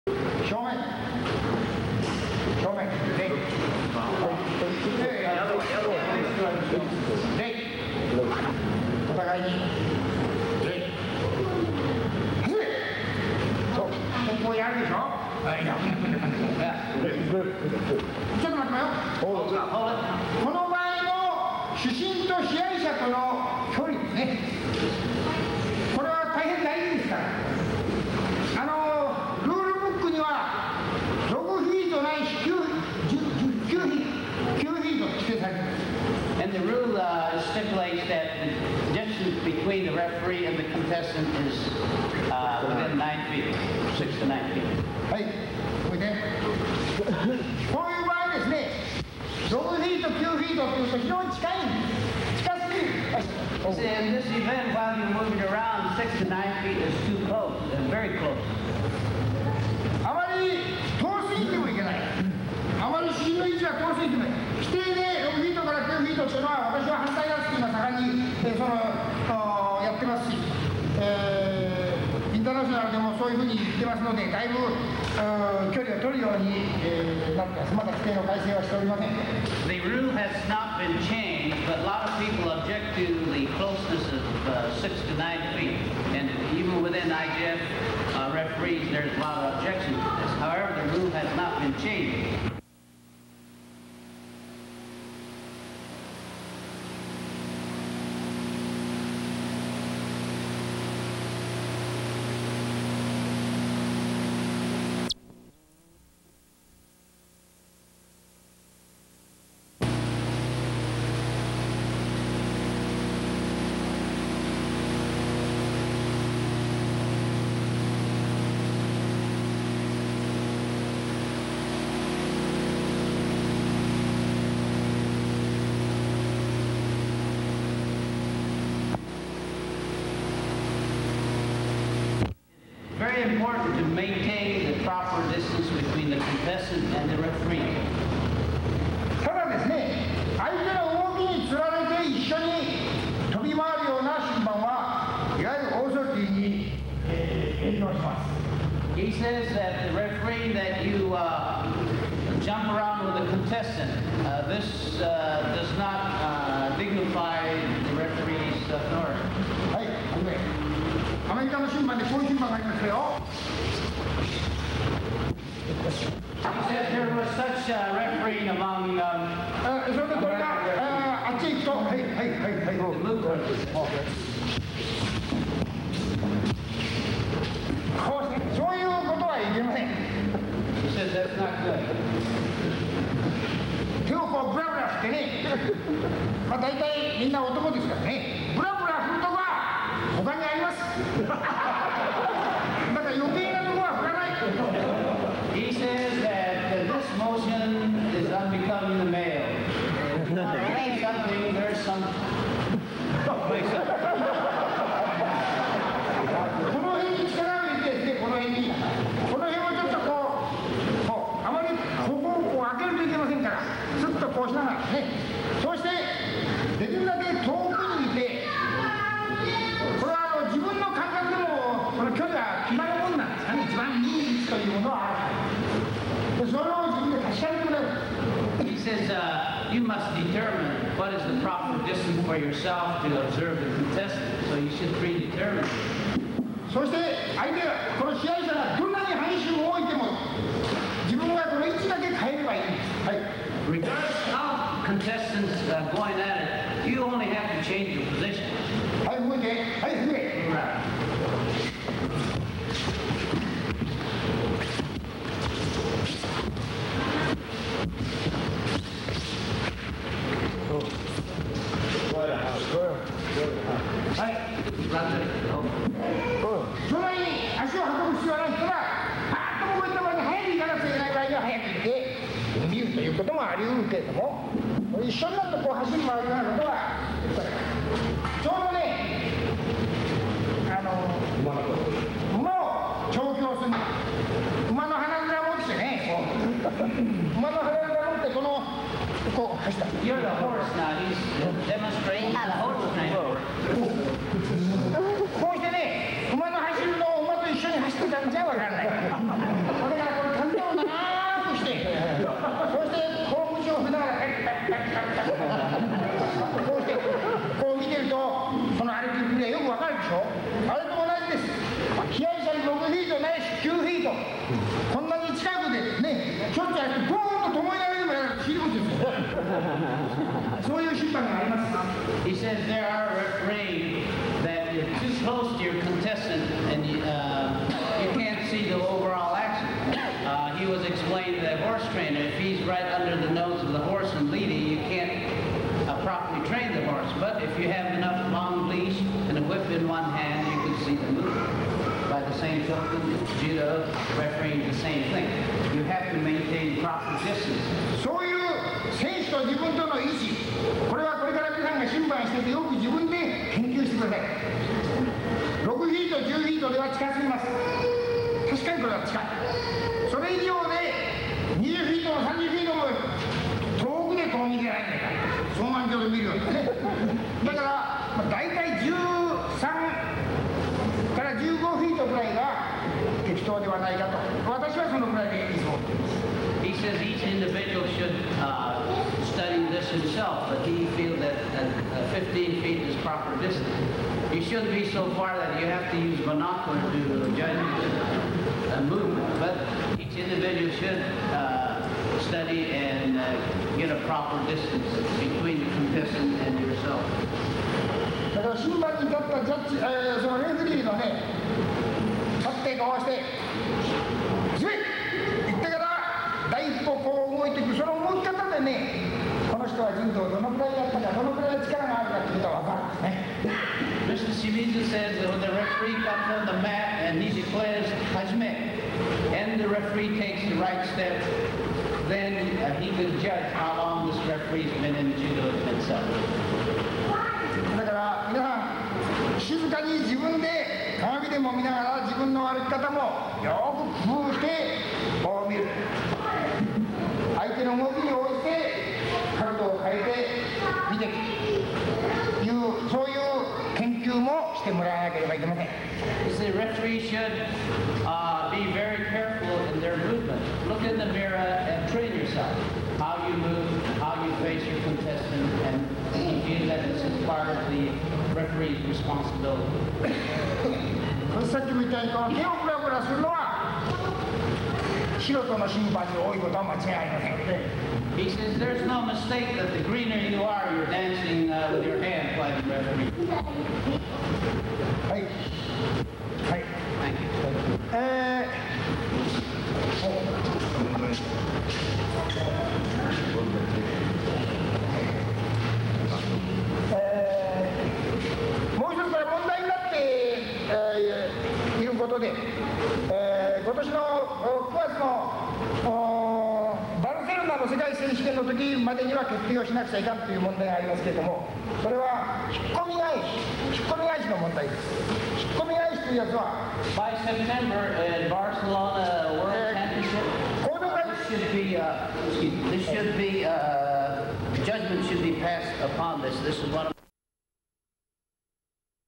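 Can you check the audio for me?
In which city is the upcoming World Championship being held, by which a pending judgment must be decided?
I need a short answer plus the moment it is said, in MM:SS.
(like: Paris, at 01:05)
Barcelona, at 08:28.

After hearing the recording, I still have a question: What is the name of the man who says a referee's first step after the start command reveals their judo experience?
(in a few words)
Mr. Shimizu.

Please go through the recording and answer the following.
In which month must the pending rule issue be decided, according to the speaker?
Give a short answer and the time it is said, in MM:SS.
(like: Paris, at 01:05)
September, at 08:27.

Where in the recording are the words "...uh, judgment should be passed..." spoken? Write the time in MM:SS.
08:33.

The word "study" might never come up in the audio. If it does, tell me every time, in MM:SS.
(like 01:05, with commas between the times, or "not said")
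06:19, 06:32.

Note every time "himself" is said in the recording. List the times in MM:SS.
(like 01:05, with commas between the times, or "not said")
06:19, 07:05.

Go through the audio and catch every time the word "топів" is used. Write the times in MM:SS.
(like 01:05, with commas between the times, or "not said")
00:50.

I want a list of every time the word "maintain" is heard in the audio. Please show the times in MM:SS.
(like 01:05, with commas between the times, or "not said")
02:13, 05:46.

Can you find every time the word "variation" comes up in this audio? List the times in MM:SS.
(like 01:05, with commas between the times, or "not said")
not said.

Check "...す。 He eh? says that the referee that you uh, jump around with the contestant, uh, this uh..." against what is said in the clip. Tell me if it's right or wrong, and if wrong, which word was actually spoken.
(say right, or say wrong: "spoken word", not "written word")
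right.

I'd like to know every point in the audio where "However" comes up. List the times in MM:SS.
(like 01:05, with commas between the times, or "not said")
01:30.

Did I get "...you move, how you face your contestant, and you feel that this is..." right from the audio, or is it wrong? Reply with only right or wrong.
right.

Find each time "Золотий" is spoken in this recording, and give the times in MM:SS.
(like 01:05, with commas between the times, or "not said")
00:49.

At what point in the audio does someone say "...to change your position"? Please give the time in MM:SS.
04:07.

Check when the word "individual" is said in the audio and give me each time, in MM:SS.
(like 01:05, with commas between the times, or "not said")
06:17, 06:30.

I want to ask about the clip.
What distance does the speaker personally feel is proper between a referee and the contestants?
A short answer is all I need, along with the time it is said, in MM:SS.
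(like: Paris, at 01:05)
15 feet, at 06:22.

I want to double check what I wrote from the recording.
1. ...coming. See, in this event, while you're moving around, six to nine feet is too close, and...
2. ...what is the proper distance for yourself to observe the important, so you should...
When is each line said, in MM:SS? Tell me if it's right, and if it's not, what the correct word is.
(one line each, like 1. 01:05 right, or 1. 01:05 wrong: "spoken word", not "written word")
1. 00:51 right
2. 03:50 wrong: "contestant", not "important".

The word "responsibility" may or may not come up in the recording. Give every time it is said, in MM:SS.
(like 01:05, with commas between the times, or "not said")
07:38.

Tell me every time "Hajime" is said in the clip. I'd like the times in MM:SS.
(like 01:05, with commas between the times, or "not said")
06:58.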